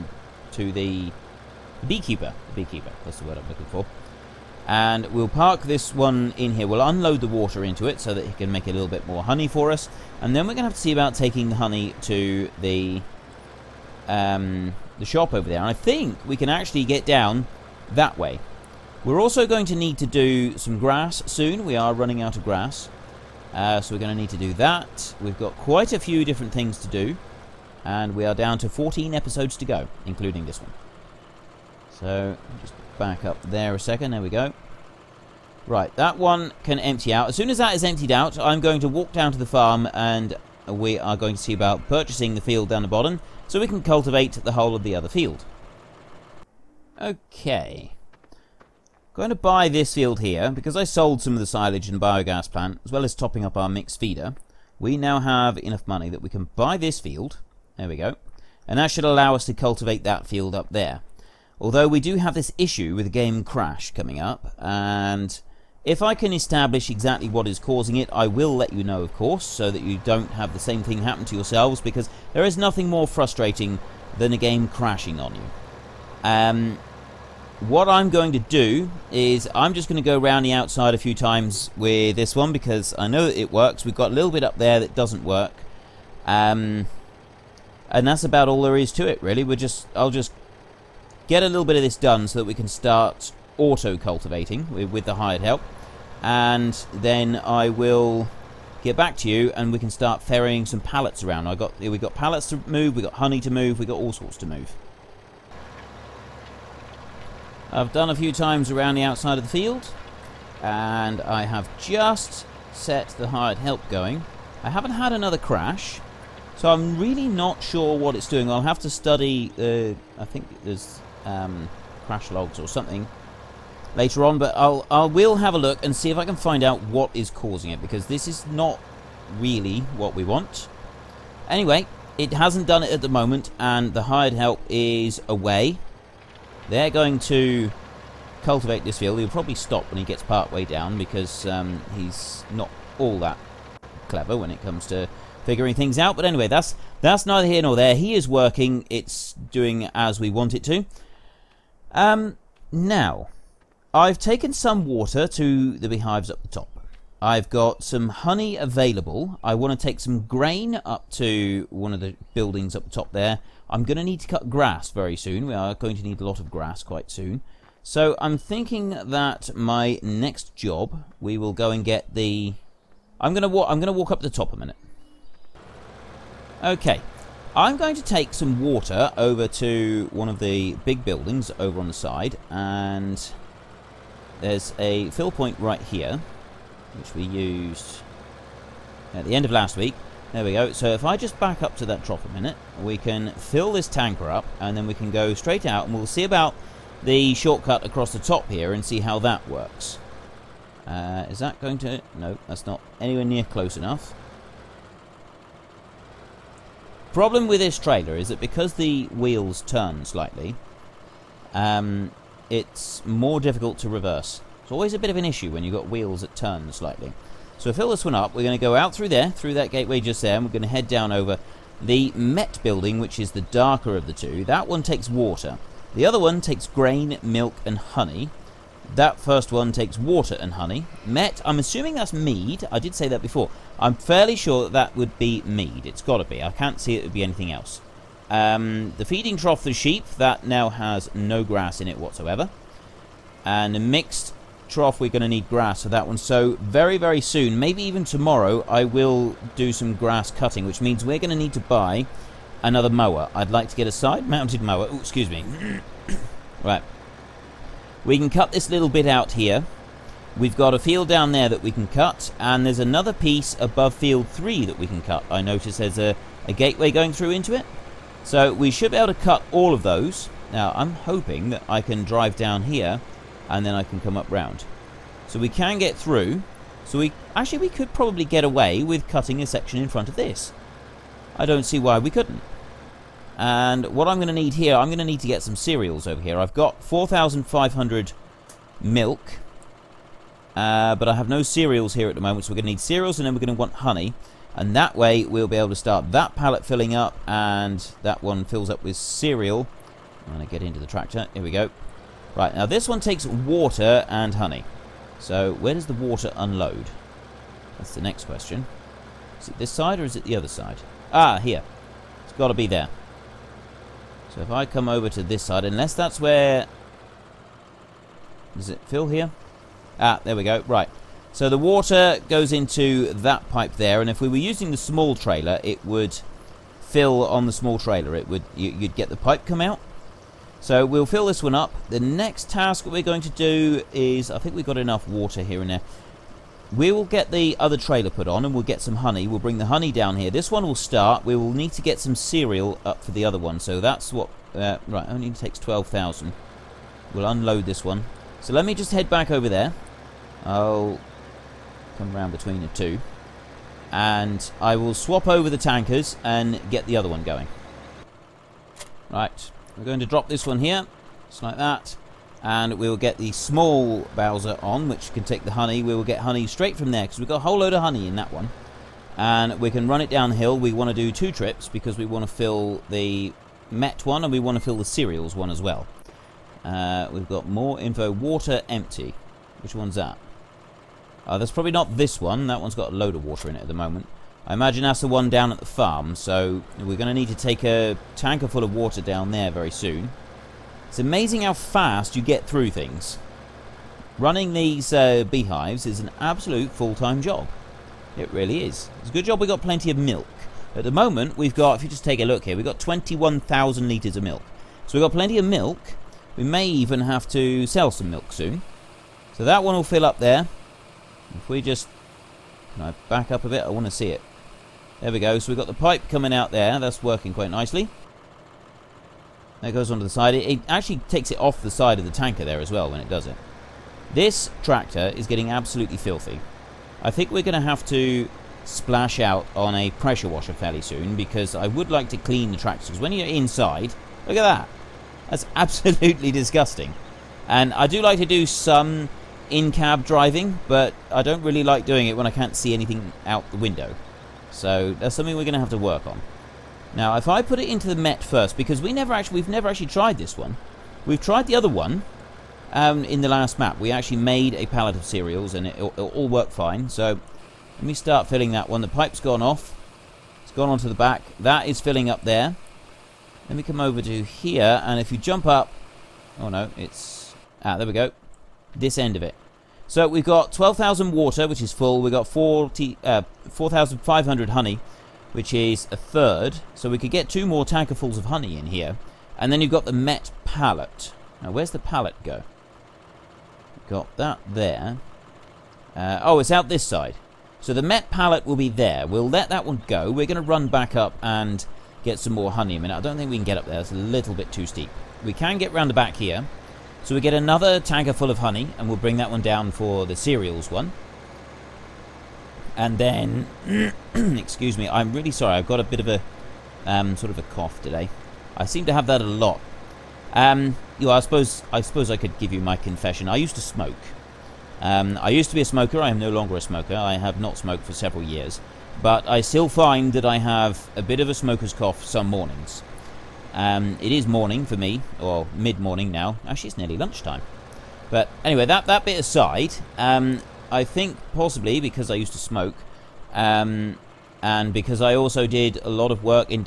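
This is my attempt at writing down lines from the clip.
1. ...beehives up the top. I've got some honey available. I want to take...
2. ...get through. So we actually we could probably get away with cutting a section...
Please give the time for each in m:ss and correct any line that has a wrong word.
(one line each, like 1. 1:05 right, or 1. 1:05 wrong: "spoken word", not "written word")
1. 2:35 right
2. 4:35 right.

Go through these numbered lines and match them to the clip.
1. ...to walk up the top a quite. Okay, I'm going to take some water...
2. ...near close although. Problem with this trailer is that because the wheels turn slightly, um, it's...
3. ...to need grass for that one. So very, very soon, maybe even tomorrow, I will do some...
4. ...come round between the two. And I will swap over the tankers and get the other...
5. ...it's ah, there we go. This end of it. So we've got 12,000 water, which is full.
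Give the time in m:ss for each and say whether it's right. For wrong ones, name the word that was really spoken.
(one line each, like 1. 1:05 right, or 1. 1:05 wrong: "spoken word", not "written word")
1. 2:53 wrong: "minute", not "quite"
2. 3:23 wrong: "enough", not "although"
3. 4:05 right
4. 5:51 right
5. 7:46 right.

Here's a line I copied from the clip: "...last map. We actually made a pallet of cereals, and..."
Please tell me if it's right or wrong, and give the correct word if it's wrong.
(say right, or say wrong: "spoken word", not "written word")
right.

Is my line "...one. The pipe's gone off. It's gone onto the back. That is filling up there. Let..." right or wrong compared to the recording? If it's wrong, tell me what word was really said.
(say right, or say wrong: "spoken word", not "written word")
right.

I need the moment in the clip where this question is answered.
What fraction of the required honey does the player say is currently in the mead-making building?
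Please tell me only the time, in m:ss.
7:55.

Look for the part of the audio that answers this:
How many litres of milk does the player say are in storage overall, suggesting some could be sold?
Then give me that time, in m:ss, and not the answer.
6:42.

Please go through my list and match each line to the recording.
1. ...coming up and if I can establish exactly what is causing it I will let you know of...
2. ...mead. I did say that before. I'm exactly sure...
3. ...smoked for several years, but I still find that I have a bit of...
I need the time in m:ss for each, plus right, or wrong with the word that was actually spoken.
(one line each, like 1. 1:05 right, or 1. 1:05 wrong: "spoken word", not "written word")
1. 1:03 right
2. 3:52 wrong: "fairly", not "exactly"
3. 8:37 right.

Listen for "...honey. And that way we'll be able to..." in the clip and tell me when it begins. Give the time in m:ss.
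4:53.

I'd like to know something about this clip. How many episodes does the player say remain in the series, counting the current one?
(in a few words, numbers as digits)
14.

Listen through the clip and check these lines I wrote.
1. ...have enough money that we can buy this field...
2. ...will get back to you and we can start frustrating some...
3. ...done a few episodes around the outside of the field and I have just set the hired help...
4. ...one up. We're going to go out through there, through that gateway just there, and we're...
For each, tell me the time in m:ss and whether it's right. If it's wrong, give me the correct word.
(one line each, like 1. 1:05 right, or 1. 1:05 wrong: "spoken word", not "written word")
1. 0:55 right
2. 1:37 wrong: "ferrying", not "frustrating"
3. 1:47 wrong: "times", not "episodes"
4. 3:38 right.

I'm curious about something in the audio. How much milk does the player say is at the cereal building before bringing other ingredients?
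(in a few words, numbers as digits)
4,500.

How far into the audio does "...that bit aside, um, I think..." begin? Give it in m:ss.
8:48.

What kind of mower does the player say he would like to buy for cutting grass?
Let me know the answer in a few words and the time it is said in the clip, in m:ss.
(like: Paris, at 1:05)
side-mounted mower, at 4:13.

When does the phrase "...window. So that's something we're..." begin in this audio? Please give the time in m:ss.
7:23.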